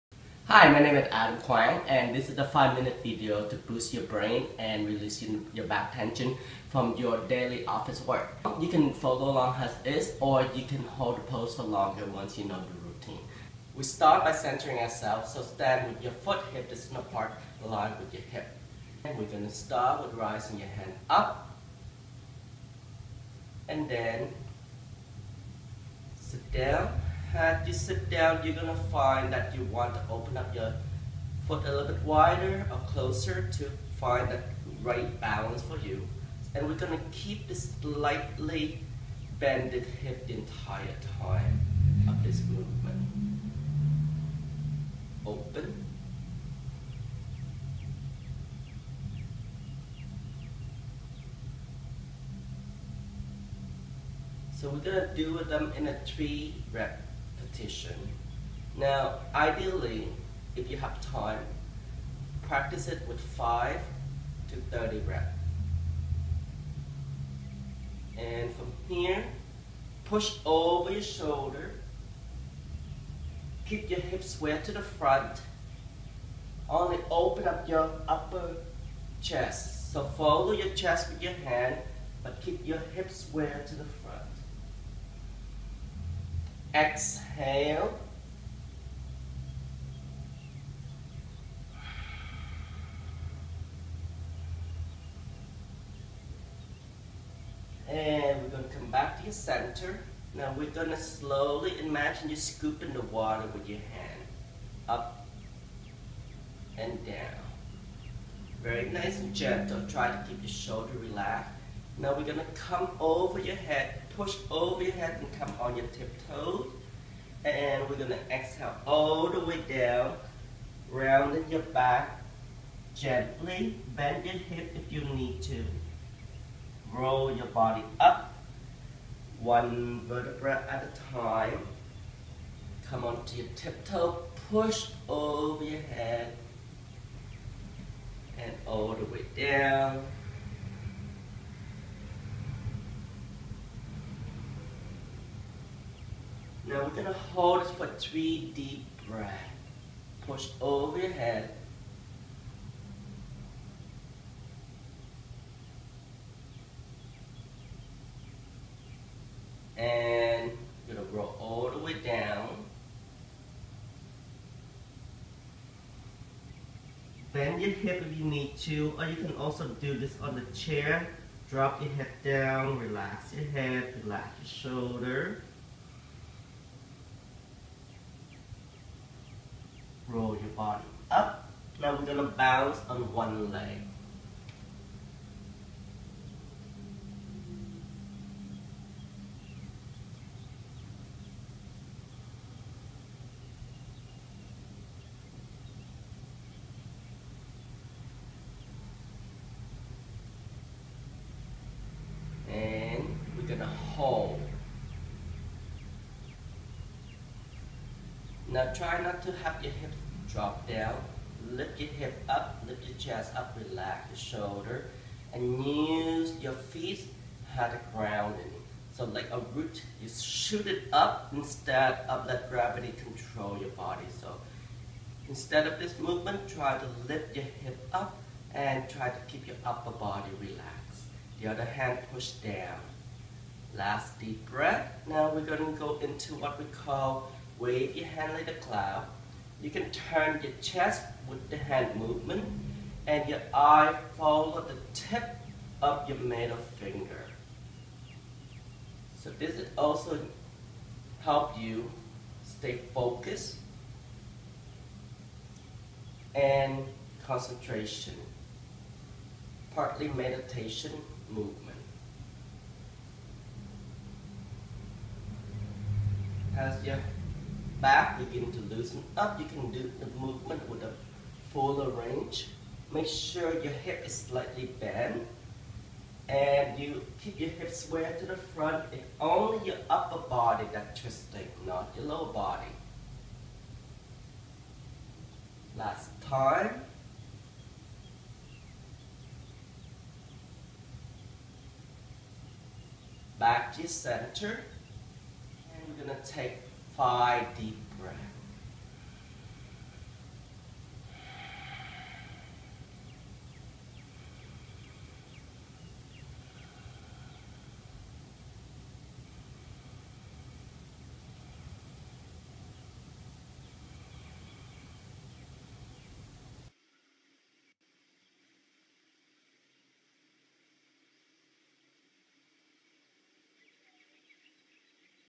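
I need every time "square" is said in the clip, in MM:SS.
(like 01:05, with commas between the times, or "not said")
01:14, 01:23, 04:37.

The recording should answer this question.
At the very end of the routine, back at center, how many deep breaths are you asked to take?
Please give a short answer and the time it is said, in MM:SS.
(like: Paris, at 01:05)
5, at 04:57.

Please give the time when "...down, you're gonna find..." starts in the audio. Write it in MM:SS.
00:28.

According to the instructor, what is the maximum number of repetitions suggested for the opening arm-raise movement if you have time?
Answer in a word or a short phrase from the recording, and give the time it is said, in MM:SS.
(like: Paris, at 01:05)
30, at 01:04.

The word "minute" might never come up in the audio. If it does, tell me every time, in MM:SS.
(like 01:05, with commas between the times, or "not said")
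00:02.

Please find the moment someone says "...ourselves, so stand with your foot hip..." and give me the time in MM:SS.
00:14.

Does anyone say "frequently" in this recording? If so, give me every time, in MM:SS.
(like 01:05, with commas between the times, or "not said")
not said.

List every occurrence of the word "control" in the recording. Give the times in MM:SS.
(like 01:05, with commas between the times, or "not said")
03:43.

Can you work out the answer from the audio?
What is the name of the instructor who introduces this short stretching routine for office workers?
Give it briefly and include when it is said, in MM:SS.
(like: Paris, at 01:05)
Adam Quang, at 00:01.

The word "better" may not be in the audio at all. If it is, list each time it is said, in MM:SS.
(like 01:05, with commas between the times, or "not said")
not said.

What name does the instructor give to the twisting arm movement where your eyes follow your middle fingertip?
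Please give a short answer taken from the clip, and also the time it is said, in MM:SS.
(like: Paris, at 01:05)
wave your hand like a cloud, at 03:57.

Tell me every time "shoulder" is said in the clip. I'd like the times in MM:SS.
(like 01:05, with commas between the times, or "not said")
01:11, 01:50, 02:54, 03:34.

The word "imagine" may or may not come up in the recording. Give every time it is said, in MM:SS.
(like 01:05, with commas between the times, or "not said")
01:41.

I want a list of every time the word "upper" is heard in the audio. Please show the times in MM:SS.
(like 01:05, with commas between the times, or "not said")
01:18, 03:49, 04:39.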